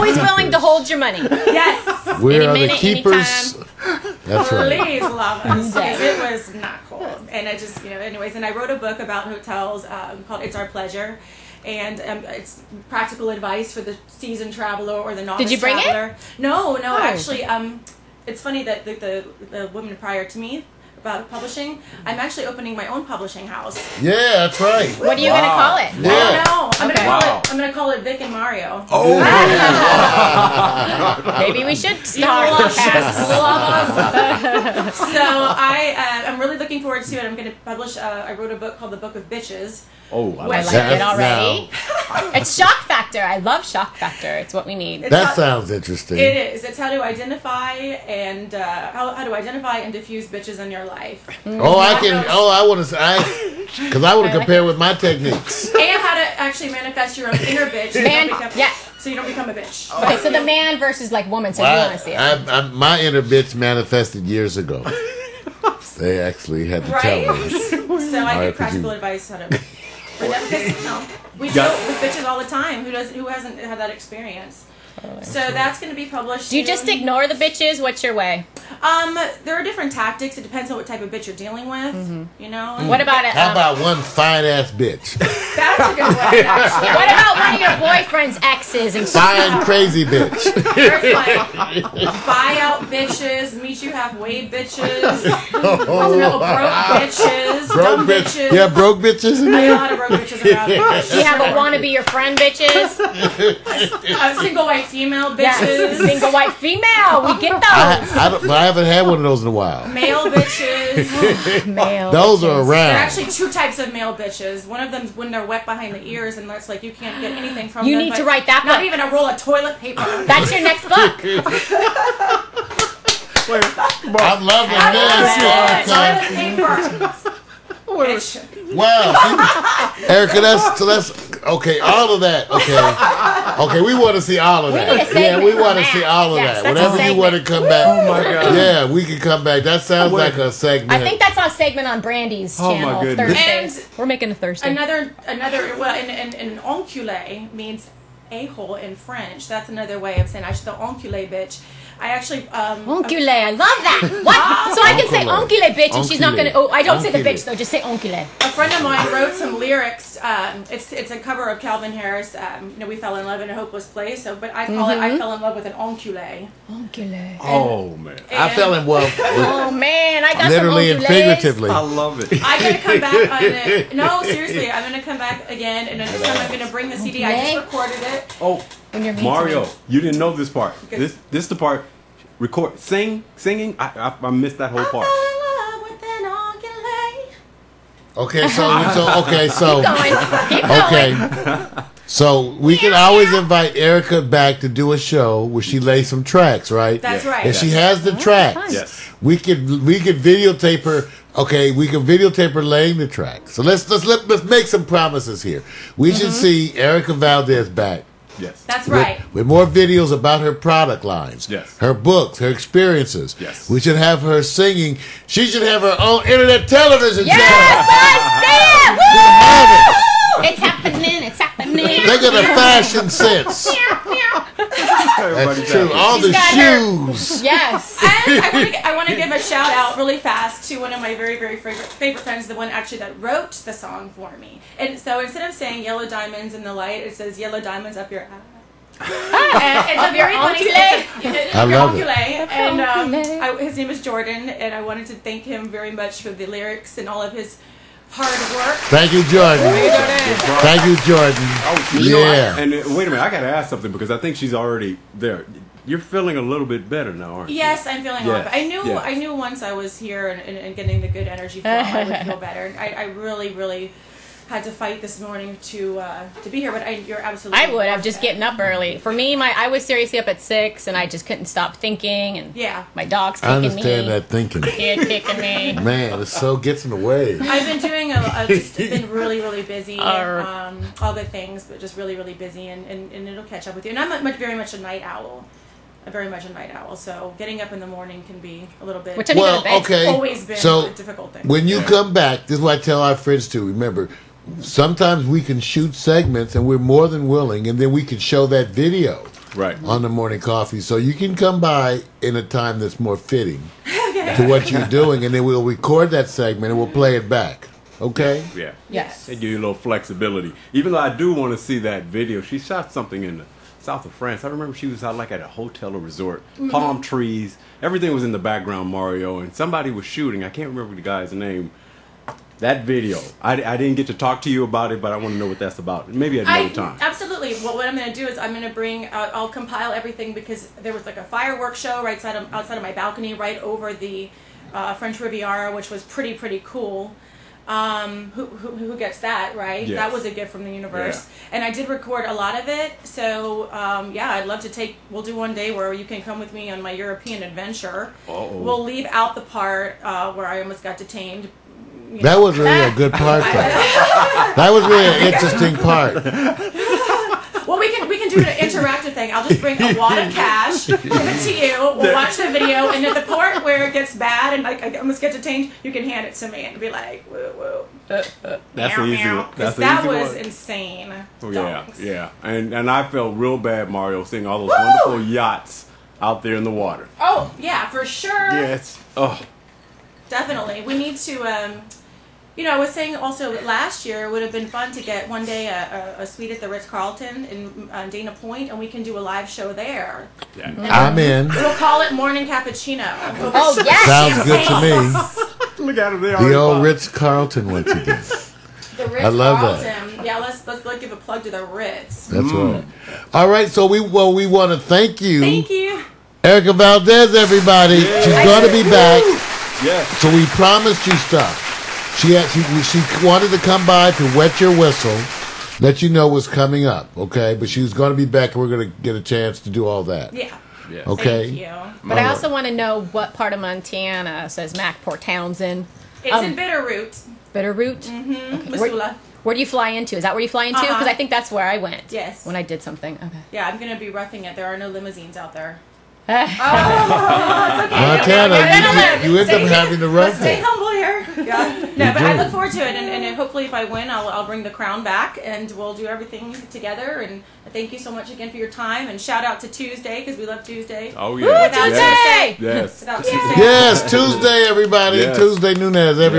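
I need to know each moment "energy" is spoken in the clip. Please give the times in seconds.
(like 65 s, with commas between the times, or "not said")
261 s.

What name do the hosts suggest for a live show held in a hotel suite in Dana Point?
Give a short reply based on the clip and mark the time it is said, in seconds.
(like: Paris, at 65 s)
Morning Cappuccino, at 392 s.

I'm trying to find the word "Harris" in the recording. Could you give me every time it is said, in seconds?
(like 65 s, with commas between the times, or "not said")
161 s.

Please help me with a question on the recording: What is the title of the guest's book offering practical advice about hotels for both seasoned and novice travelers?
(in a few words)
It's Our Pleasure.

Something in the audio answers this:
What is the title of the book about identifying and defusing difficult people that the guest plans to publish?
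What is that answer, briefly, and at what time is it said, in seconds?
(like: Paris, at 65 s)
The Book of Bitches, at 38 s.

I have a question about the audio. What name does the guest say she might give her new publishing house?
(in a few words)
Vic and Mario.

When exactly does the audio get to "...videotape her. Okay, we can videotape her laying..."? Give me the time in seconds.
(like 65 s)
200 s.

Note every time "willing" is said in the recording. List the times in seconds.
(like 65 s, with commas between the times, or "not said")
0 s, 297 s.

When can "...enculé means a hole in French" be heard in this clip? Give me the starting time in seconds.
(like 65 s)
146 s.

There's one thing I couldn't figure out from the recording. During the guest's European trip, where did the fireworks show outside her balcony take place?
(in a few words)
French Riviera.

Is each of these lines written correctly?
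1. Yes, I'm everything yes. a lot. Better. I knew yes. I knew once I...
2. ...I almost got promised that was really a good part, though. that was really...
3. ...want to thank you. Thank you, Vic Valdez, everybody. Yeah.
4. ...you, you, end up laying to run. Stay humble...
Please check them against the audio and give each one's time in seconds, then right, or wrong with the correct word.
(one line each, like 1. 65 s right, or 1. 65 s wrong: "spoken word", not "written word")
1. 257 s wrong: "feeling", not "everything"
2. 350 s wrong: "detained", not "promised"
3. 404 s wrong: "Erika", not "Vic"
4. 439 s wrong: "having", not "laying".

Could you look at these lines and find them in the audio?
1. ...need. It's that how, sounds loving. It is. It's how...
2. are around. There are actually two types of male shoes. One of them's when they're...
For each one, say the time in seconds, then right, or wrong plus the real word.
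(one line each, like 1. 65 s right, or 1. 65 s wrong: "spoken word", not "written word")
1. 44 s wrong: "interesting", not "loving"
2. 112 s wrong: "bitches", not "shoes".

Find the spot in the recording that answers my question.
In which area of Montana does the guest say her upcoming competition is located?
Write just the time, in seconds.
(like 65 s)
426 s.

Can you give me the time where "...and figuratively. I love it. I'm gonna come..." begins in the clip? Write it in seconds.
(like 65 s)
170 s.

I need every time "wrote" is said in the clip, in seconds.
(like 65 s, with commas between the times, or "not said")
8 s, 38 s, 159 s, 233 s.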